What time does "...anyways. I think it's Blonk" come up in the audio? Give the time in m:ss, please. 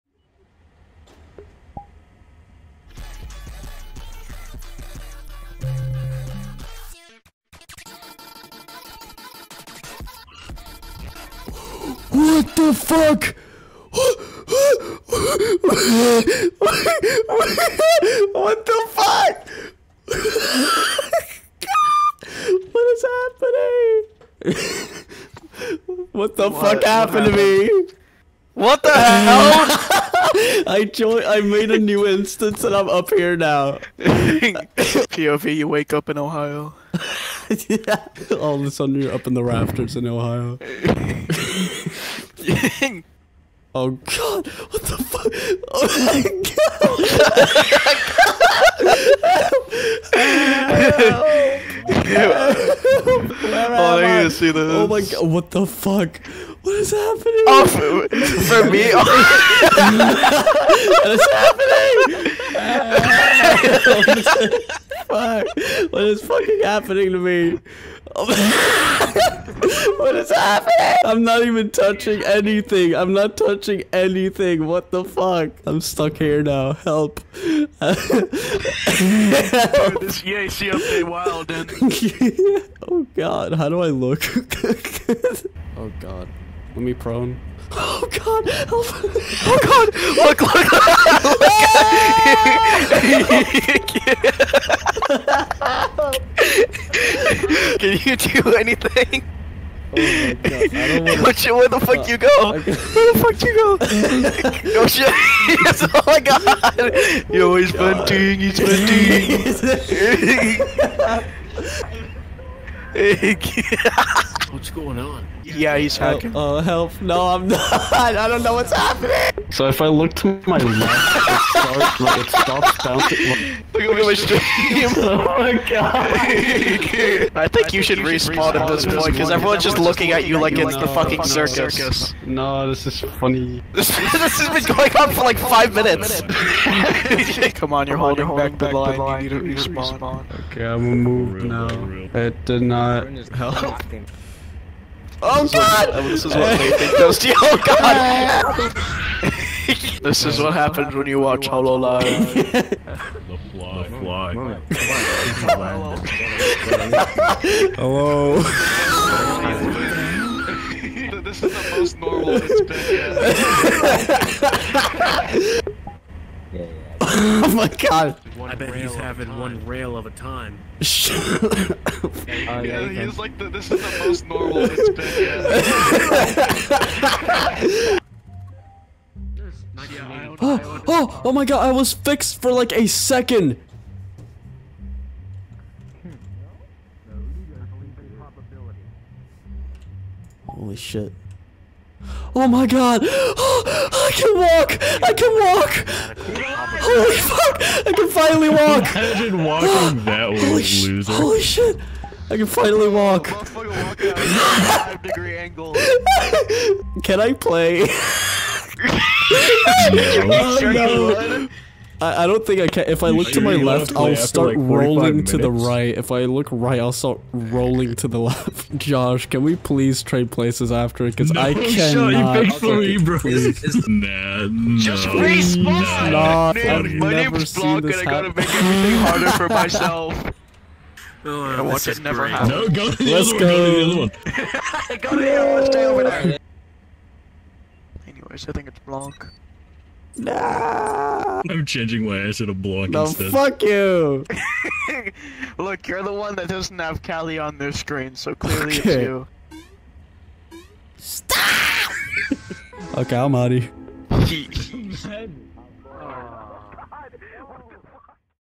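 3:58.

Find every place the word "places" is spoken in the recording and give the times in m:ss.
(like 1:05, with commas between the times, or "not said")
3:40.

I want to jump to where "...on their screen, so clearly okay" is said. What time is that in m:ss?
4:07.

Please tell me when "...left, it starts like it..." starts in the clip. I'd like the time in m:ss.
2:00.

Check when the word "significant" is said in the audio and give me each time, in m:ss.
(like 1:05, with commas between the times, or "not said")
not said.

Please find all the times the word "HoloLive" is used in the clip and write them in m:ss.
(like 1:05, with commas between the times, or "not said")
2:31.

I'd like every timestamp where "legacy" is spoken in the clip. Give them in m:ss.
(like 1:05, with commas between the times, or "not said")
not said.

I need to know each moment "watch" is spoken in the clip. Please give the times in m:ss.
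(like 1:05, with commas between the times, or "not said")
2:31, 3:51.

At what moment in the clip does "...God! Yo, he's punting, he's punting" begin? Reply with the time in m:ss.
1:46.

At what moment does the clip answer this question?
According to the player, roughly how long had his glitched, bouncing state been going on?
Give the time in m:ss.
2:15.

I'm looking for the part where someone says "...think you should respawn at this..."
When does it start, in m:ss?
2:07.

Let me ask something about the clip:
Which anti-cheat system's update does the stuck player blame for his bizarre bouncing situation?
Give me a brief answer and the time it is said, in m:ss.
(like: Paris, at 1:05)
EAC, at 1:20.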